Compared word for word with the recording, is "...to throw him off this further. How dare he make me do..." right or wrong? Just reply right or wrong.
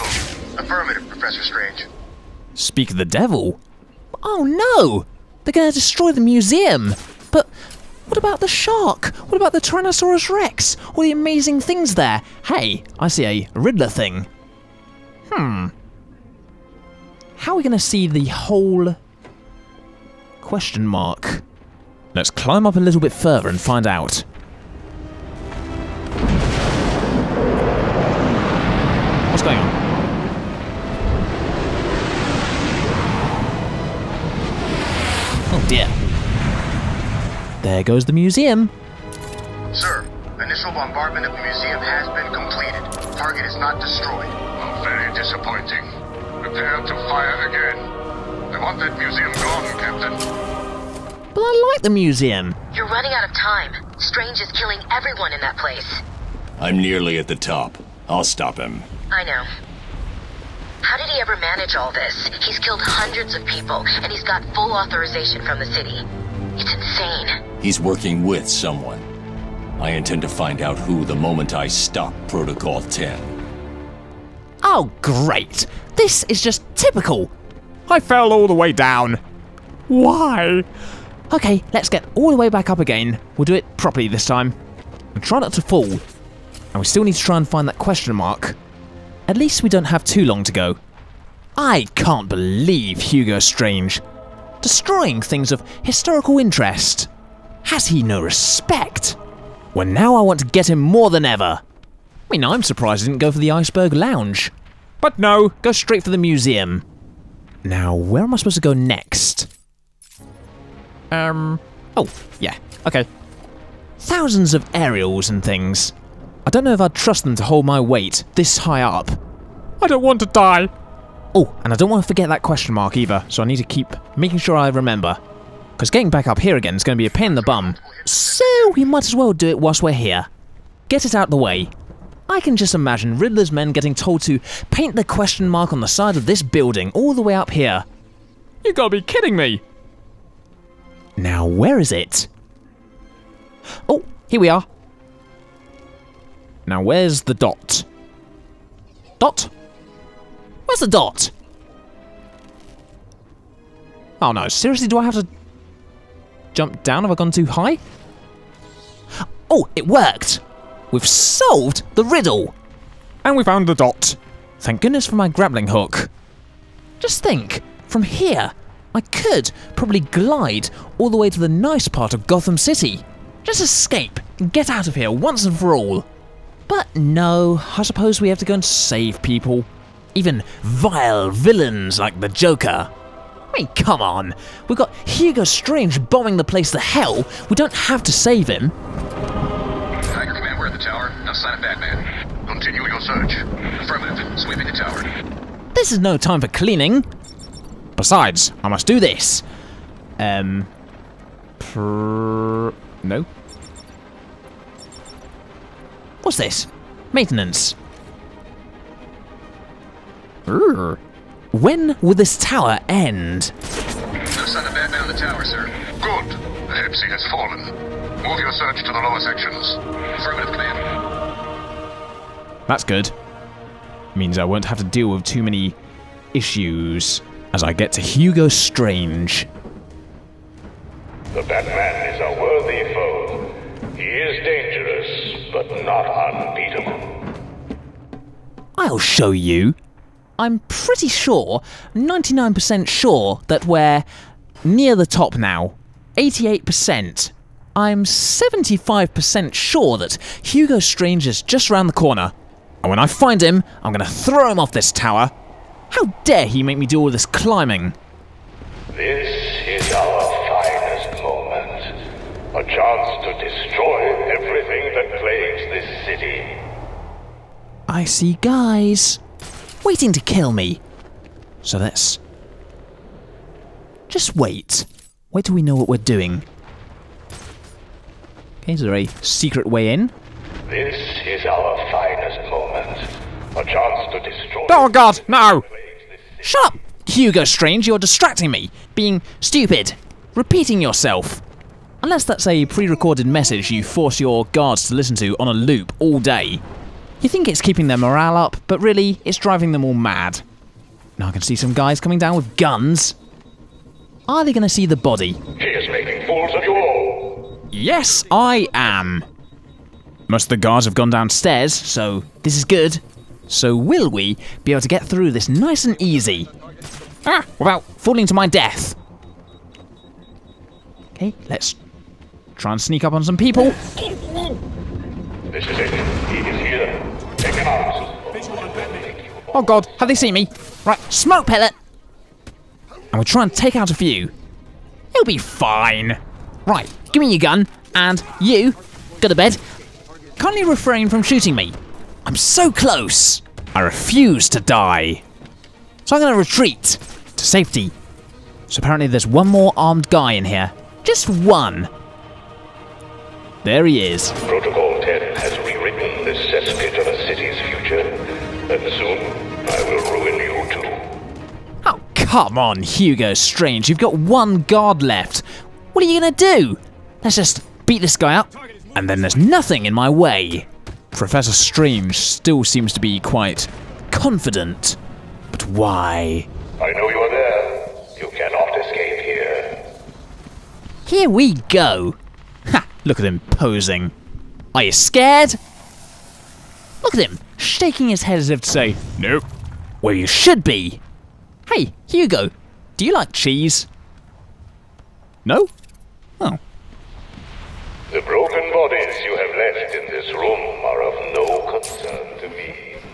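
wrong.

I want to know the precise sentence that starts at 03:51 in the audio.
The Batman is a worthy foe.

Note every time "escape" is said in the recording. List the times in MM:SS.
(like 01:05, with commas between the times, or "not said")
02:53, 06:18.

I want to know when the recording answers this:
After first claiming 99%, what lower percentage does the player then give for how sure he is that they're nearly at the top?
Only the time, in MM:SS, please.
04:06.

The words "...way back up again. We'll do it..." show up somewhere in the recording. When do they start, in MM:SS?
01:22.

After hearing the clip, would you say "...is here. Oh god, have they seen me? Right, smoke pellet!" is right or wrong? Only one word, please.
right.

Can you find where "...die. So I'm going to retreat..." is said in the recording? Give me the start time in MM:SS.
05:44.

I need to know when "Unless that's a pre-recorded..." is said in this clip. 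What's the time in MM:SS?
04:52.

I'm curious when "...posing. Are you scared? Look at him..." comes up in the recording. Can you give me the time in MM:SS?
06:23.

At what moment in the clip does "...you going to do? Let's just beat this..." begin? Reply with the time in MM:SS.
06:06.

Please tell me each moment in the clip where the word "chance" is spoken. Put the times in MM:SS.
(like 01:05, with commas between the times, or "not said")
04:22, 04:43.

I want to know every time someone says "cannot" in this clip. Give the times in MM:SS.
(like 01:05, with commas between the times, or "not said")
06:18.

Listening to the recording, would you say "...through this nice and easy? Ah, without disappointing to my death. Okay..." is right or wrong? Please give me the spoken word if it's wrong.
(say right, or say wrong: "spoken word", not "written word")
wrong: "falling", not "disappointing".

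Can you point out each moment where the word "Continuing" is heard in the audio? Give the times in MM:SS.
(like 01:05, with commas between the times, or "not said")
03:12.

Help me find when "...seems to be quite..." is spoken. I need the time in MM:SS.
06:12.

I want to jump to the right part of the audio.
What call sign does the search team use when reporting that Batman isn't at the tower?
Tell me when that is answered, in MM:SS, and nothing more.
03:10.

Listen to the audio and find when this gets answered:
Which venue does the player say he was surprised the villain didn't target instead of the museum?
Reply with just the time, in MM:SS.
01:43.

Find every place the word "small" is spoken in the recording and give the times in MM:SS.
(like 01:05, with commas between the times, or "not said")
not said.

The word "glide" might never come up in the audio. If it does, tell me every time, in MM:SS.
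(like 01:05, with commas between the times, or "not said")
02:50.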